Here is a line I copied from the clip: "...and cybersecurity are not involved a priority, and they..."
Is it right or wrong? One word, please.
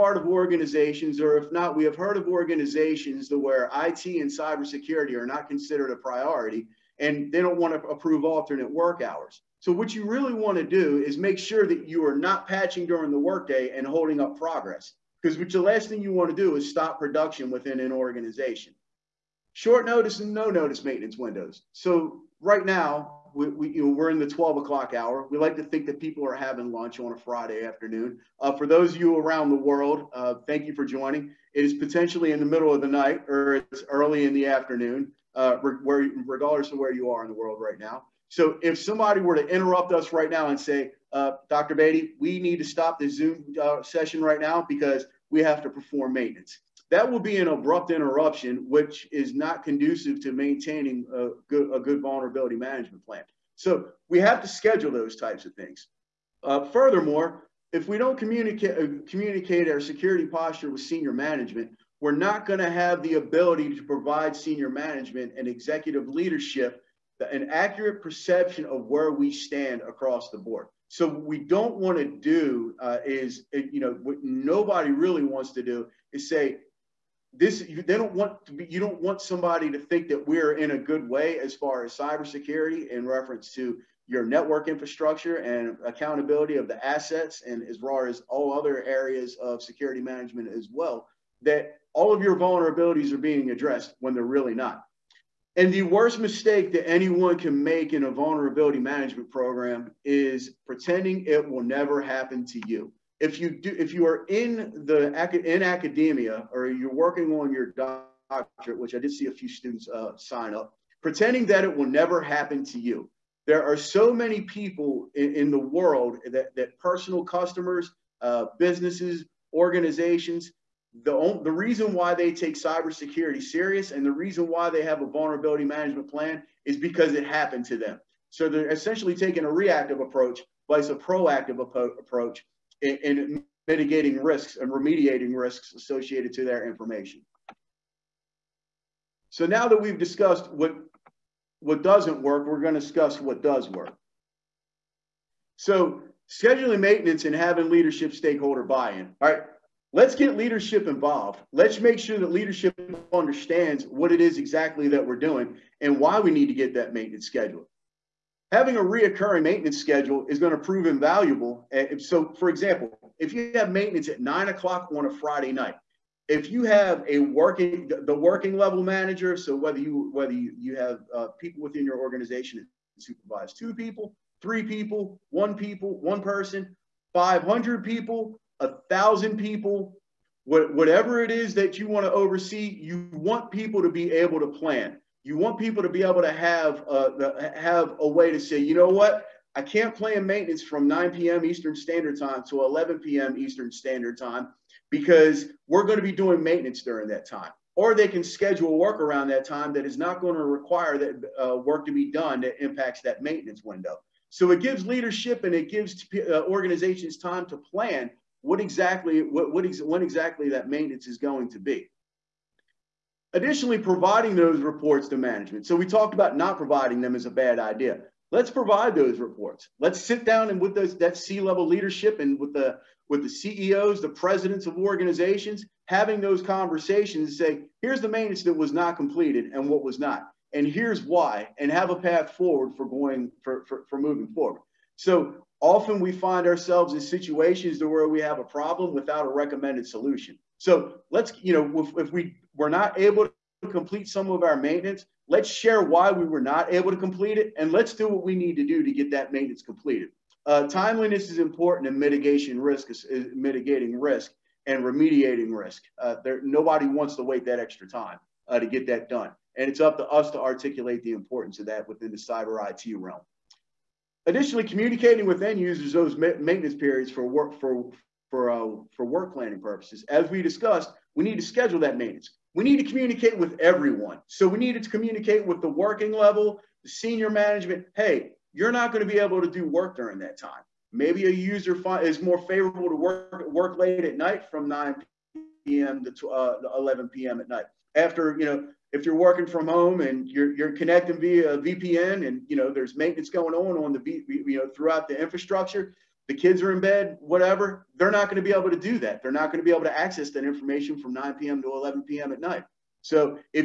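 wrong.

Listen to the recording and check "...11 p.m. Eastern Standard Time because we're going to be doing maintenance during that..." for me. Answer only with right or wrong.
right.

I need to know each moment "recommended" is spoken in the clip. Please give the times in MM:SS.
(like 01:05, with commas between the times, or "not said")
03:59.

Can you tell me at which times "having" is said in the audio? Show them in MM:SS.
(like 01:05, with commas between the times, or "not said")
00:26, 02:27, 02:38, 03:45.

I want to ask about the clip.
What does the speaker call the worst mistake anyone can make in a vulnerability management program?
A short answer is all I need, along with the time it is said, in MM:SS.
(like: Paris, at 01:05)
Pretending it will never happen to you, at 01:40.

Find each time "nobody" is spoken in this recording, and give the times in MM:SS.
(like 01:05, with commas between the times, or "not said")
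01:14, 04:16.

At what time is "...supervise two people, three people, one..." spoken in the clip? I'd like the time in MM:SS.
02:53.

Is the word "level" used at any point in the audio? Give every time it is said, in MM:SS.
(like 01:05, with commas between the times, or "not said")
02:48, 03:41, 04:36.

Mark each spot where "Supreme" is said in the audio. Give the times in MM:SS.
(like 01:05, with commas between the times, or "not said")
not said.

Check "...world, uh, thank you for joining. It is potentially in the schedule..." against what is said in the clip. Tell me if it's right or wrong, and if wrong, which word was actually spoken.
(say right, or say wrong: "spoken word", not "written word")
wrong: "middle", not "schedule".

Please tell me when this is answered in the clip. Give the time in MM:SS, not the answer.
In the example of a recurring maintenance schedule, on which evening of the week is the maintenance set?
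02:45.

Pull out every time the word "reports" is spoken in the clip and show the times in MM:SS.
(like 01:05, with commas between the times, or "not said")
03:34, 03:39.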